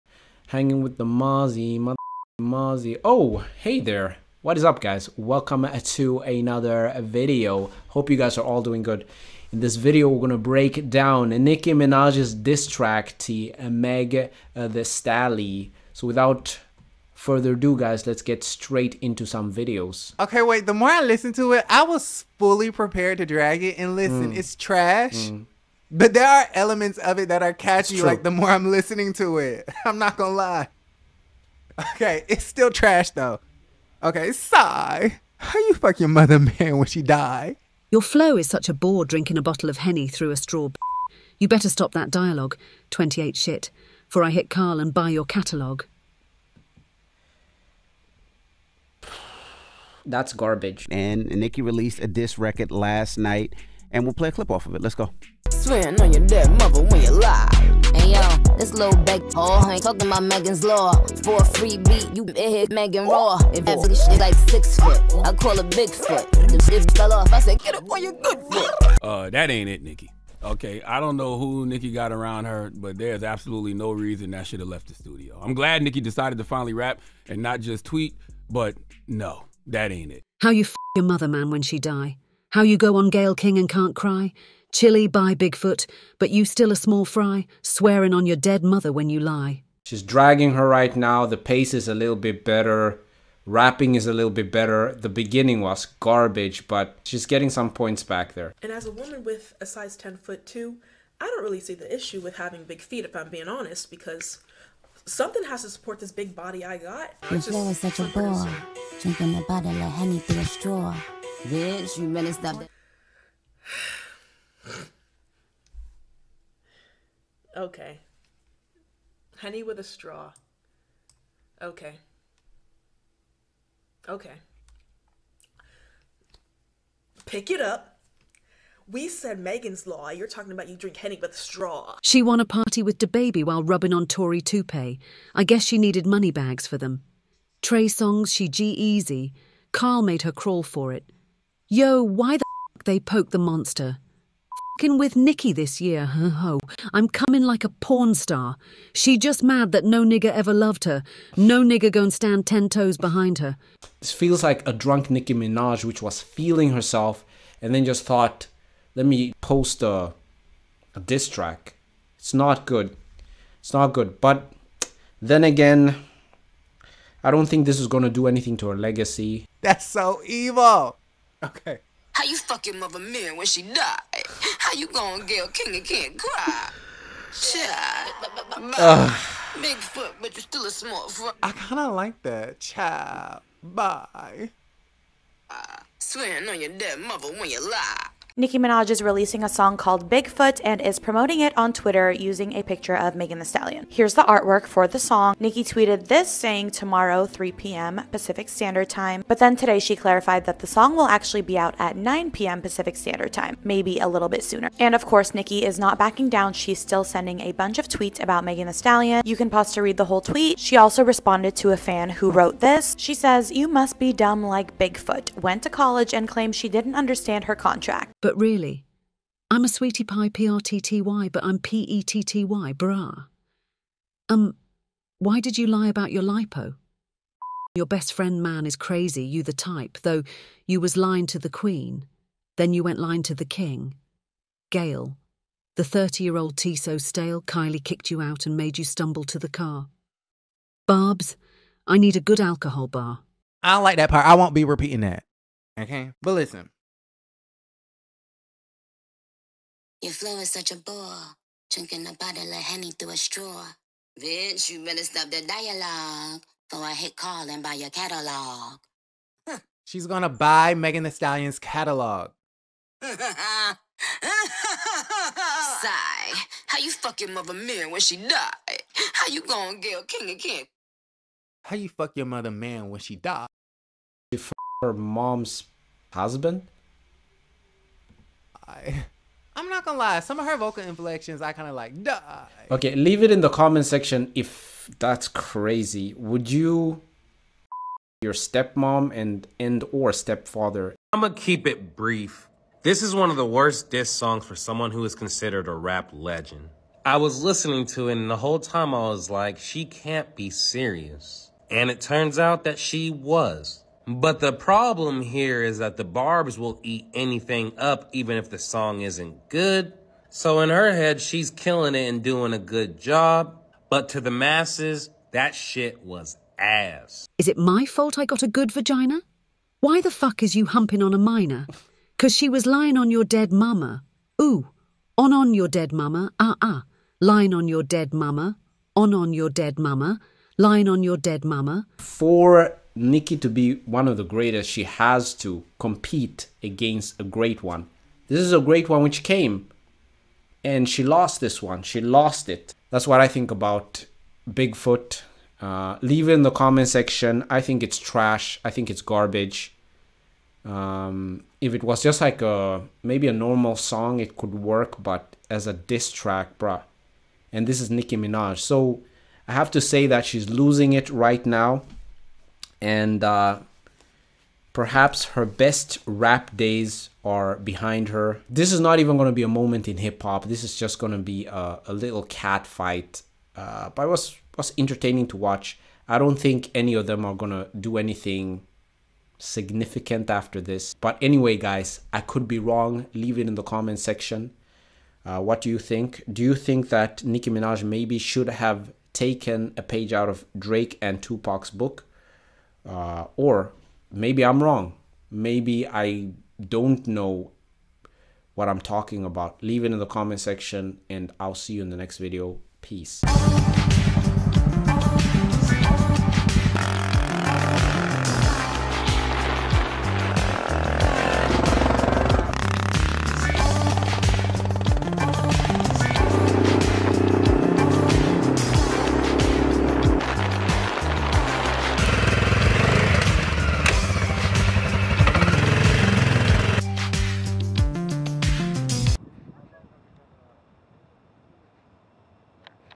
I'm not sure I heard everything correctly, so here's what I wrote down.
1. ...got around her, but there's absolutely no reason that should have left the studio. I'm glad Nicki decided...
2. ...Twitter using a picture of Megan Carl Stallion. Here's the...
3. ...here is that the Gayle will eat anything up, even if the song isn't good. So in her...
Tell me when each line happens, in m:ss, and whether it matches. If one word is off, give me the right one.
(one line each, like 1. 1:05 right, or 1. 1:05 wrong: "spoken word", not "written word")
1. 1:11 right
2. 3:11 wrong: "Thee", not "Carl"
3. 5:05 wrong: "Barbs", not "Gayle".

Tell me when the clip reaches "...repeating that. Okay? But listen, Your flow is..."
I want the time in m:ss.
4:04.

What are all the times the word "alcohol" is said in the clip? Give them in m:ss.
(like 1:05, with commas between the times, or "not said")
4:02.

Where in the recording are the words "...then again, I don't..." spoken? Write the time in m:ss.
2:45.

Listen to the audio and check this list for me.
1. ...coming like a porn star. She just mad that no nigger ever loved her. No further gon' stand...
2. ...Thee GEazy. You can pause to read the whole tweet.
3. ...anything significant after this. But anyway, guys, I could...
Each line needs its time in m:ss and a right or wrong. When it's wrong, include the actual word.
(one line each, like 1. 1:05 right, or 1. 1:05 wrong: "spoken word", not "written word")
1. 2:27 wrong: "nigger", not "further"
2. 3:28 wrong: "Stallion", not "GEazy"
3. 6:17 right.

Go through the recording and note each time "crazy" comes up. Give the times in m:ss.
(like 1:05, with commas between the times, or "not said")
3:48, 4:45.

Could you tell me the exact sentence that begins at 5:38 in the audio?
This is a great one which came and she lost this one.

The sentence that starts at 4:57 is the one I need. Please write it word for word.
I was listening to it and the whole time I was like, she can't be serious.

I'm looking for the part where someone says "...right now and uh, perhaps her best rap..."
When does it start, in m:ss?
6:01.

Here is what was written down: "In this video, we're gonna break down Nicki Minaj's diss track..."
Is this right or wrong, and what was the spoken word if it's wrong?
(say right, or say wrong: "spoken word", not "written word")
right.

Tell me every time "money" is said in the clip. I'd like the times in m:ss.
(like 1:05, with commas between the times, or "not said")
2:16.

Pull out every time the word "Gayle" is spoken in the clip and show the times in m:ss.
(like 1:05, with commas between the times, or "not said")
1:23, 2:55.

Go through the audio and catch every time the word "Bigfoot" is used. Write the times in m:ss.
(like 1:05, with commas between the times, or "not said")
1:25, 3:10, 3:34, 5:44.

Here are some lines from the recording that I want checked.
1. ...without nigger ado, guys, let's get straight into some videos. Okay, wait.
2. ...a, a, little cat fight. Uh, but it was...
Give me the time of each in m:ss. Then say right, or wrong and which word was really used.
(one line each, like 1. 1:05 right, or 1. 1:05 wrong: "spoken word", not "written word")
1. 0:16 wrong: "further", not "nigger"
2. 6:11 right.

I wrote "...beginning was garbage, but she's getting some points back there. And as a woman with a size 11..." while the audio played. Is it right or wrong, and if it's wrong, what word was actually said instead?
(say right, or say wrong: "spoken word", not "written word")
wrong: "10", not "11".